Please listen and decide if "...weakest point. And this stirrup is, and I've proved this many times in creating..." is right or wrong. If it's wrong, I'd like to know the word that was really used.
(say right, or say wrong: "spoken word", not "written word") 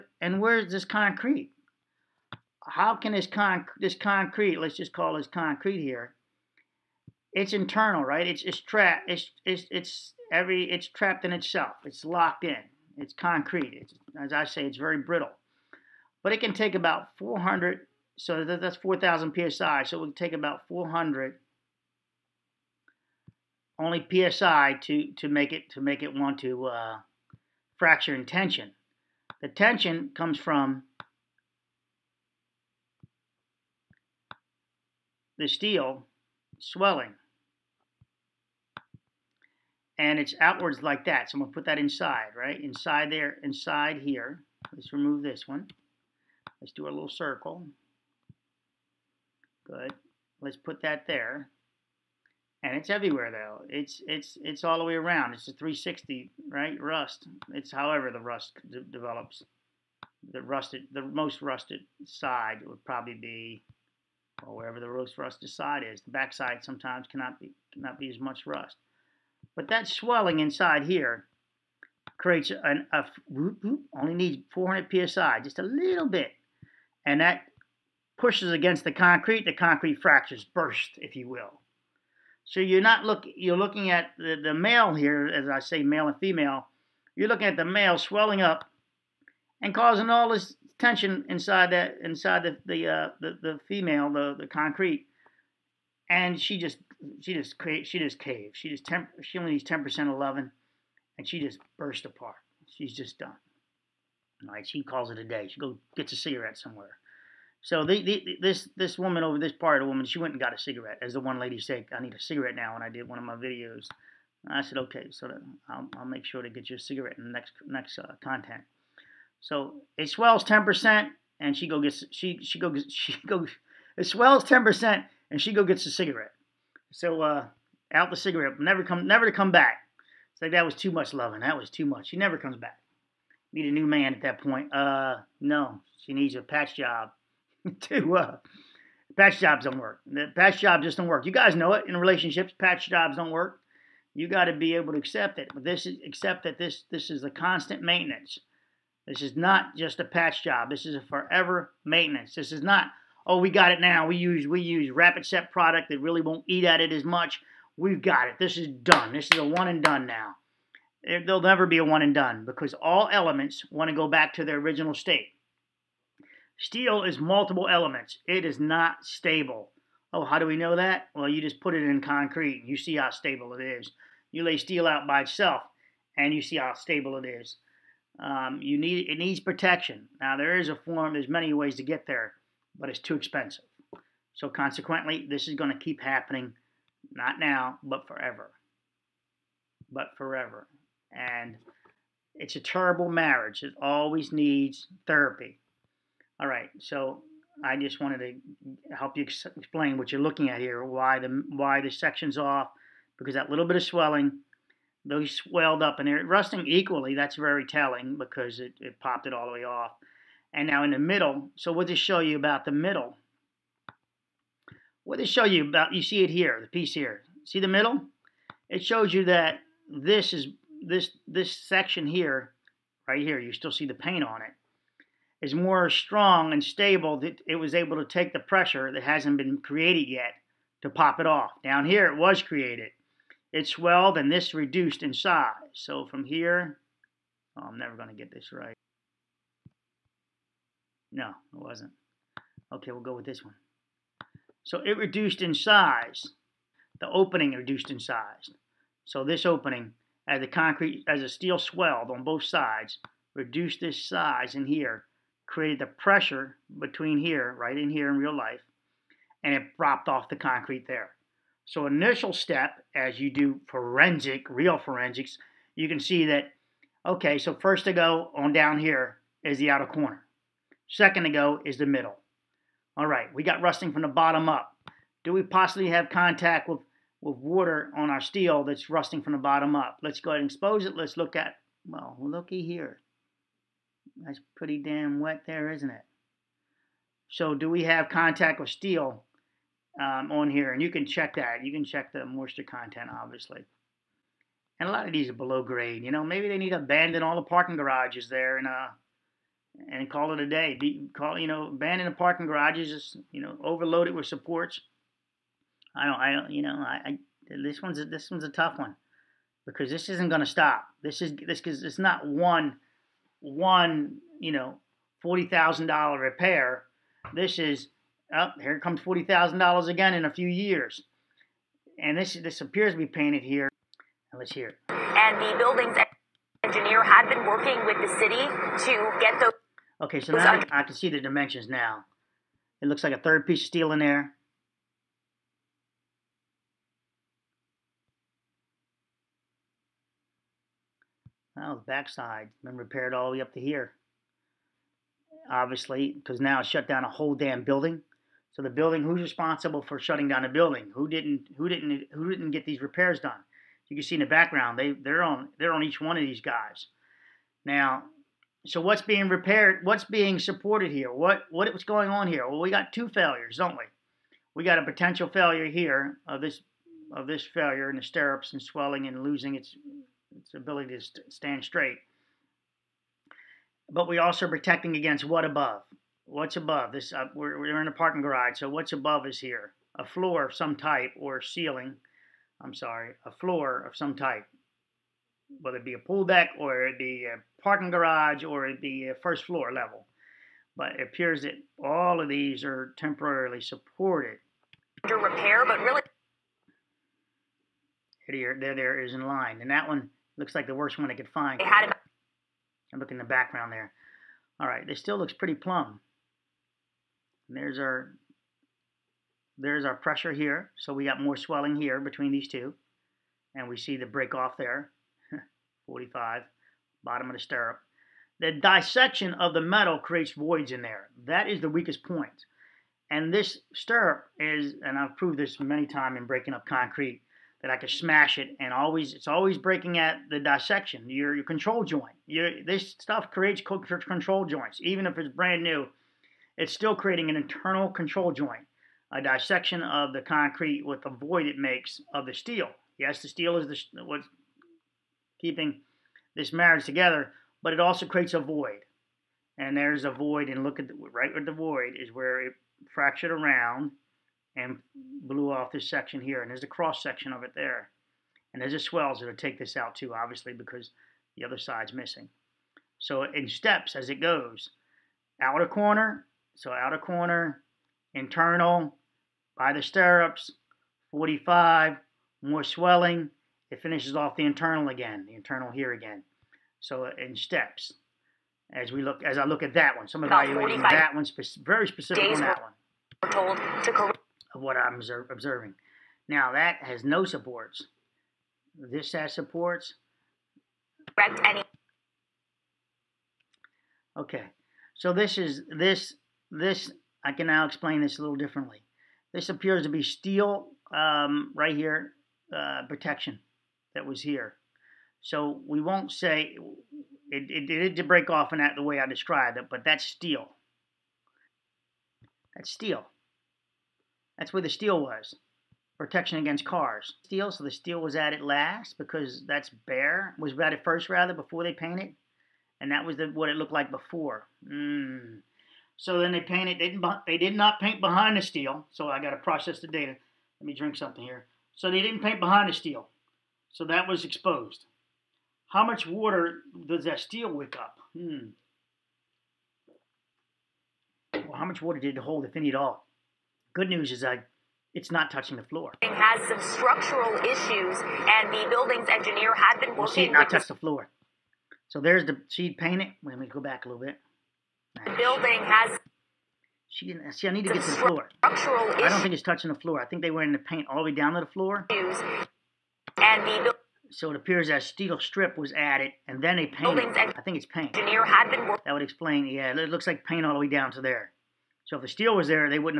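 wrong: "breaking", not "creating".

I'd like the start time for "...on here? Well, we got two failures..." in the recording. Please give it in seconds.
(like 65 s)
362 s.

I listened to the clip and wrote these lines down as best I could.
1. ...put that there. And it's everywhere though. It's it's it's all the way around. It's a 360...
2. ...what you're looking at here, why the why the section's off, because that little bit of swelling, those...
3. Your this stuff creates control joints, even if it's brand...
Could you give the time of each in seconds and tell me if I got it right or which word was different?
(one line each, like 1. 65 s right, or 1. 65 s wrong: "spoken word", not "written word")
1. 50 s right
2. 199 s right
3. 432 s right.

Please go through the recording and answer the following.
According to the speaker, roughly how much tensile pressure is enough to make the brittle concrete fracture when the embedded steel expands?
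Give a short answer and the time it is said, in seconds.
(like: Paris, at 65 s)
400 psi, at 20 s.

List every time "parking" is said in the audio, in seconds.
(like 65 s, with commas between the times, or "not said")
297 s, 302 s, 377 s, 387 s.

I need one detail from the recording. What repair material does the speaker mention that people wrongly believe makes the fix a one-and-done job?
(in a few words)
rapid set.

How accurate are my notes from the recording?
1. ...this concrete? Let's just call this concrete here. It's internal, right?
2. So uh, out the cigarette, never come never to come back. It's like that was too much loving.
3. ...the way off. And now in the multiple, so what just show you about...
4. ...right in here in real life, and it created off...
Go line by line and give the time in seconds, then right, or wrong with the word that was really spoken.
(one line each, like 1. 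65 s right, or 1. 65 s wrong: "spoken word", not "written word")
1. 3 s right
2. 126 s right
3. 209 s wrong: "middle", not "multiple"
4. 257 s wrong: "dropped", not "created".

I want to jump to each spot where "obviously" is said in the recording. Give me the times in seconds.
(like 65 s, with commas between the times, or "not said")
293 s, 345 s, 460 s.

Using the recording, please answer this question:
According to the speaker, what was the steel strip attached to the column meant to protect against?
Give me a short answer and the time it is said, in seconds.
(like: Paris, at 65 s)
cars, at 516 s.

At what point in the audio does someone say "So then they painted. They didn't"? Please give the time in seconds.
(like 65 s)
525 s.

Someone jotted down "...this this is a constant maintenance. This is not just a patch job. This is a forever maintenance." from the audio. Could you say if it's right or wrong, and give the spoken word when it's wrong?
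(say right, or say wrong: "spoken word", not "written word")
right.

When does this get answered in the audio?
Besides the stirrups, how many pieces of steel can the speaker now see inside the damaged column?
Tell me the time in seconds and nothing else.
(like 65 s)
333 s.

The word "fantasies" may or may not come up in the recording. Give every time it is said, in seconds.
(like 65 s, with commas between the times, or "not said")
not said.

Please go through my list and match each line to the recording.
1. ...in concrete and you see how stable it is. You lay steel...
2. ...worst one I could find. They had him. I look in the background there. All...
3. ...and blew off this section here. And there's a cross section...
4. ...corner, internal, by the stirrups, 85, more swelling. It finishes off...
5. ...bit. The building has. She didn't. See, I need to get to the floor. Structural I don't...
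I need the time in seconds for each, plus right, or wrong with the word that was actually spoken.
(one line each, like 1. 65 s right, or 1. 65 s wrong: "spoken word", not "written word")
1. 171 s right
2. 400 s right
3. 454 s right
4. 466 s wrong: "45", not "85"
5. 554 s right.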